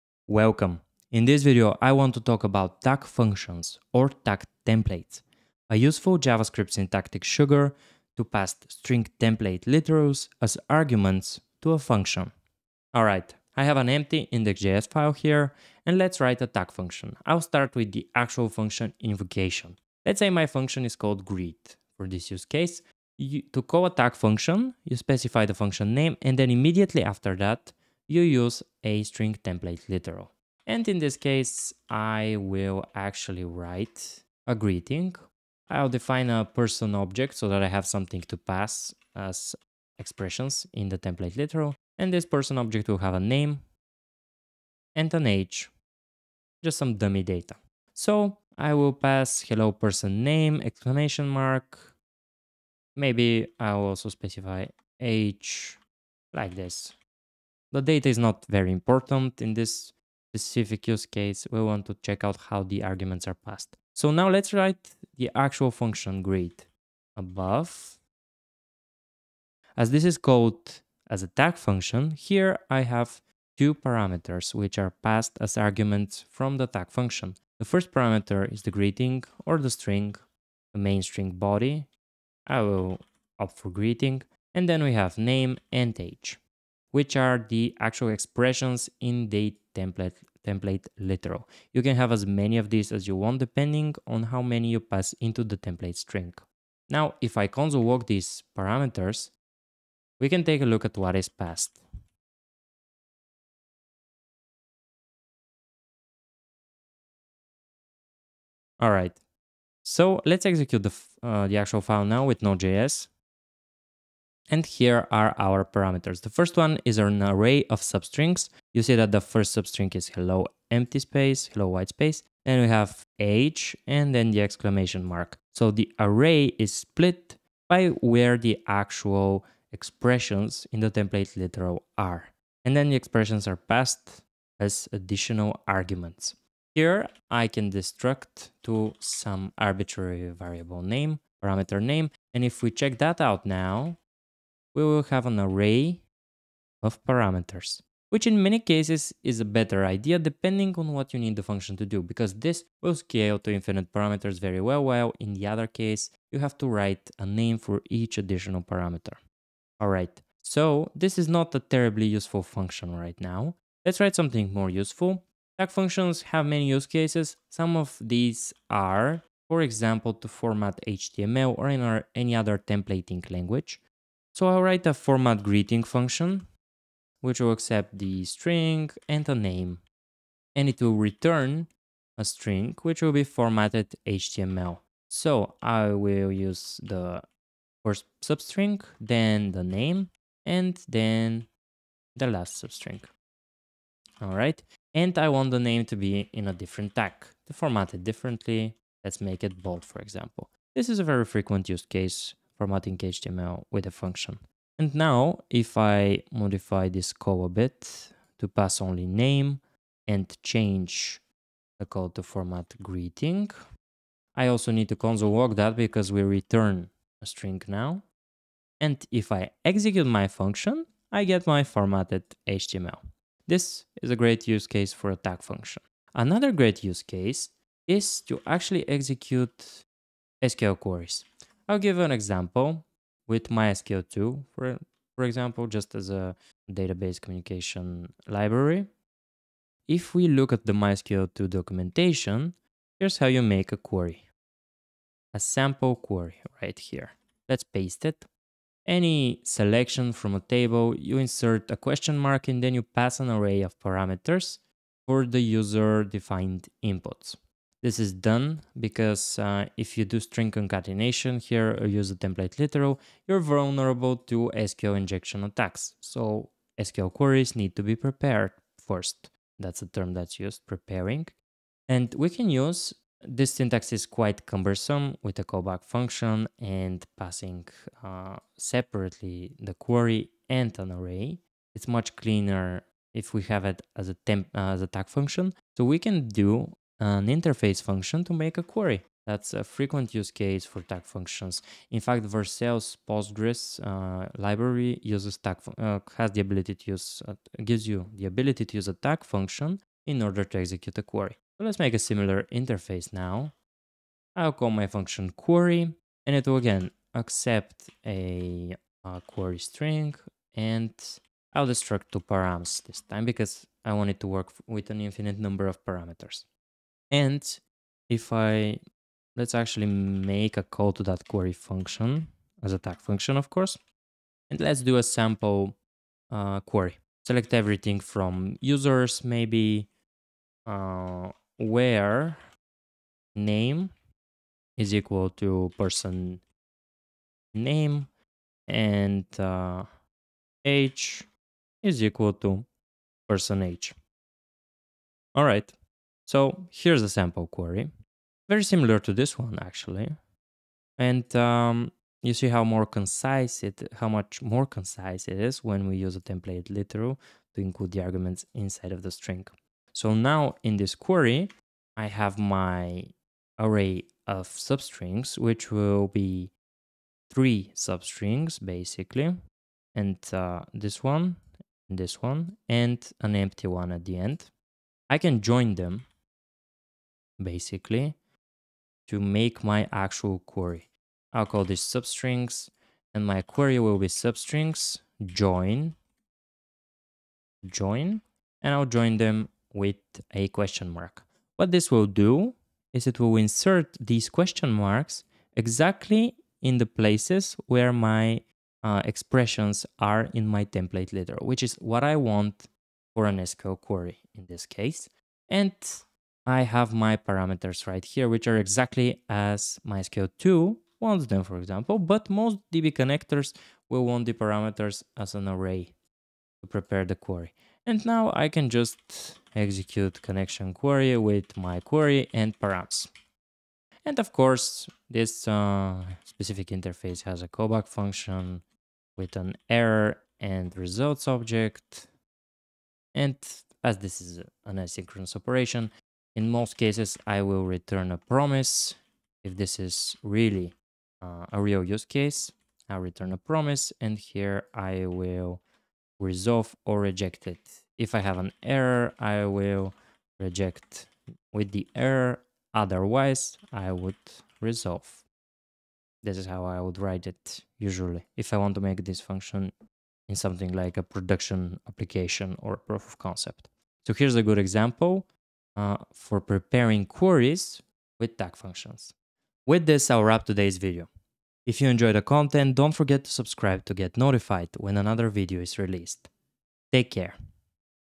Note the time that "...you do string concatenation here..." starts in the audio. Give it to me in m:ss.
4:19.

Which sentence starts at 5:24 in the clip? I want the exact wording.
And let's do a sample uh, query.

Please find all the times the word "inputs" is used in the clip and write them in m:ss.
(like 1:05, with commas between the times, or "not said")
4:16.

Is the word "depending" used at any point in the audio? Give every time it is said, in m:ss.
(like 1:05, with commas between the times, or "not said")
1:33, 2:30.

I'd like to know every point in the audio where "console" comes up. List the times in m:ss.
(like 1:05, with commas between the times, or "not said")
1:37, 3:34.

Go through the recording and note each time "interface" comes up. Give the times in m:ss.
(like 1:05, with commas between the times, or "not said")
4:47, 5:02, 7:06.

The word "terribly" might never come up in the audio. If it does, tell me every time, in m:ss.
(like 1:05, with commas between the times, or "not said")
2:41.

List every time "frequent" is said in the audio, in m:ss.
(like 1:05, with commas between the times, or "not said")
3:21, 4:49.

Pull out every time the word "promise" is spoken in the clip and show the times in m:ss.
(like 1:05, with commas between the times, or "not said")
7:18, 7:23.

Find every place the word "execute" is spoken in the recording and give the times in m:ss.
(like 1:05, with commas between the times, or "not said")
1:50, 3:39, 3:48, 5:00, 6:59.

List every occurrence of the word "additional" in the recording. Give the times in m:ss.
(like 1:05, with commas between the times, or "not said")
2:14, 2:38.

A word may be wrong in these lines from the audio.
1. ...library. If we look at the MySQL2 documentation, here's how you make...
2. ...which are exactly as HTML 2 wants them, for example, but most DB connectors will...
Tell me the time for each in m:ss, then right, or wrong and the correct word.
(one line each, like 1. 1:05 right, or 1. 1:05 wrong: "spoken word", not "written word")
1. 3:58 right
2. 6:48 wrong: "MySQL", not "HTML".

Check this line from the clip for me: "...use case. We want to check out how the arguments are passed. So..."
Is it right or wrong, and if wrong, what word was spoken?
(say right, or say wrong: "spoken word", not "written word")
right.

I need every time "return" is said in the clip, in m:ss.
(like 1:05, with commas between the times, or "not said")
3:00, 3:36, 7:17, 7:22.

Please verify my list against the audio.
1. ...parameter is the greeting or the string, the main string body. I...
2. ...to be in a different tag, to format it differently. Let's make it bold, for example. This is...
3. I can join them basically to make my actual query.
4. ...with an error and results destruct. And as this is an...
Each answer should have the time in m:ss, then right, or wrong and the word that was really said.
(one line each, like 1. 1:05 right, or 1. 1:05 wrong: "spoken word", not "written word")
1. 1:17 right
2. 3:15 right
3. 6:15 right
4. 7:09 wrong: "object", not "destruct".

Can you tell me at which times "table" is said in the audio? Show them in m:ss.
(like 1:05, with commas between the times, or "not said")
4:10.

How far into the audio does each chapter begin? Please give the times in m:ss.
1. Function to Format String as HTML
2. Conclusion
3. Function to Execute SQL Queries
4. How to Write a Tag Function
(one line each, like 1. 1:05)
1. 2:43
2. 7:43
3. 3:45
4. 0:12.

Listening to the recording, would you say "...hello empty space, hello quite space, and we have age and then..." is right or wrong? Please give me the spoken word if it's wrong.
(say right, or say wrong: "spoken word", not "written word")
wrong: "white", not "quite".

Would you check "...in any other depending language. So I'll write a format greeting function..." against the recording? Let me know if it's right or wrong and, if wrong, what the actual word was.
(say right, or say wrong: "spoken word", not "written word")
wrong: "templating", not "depending".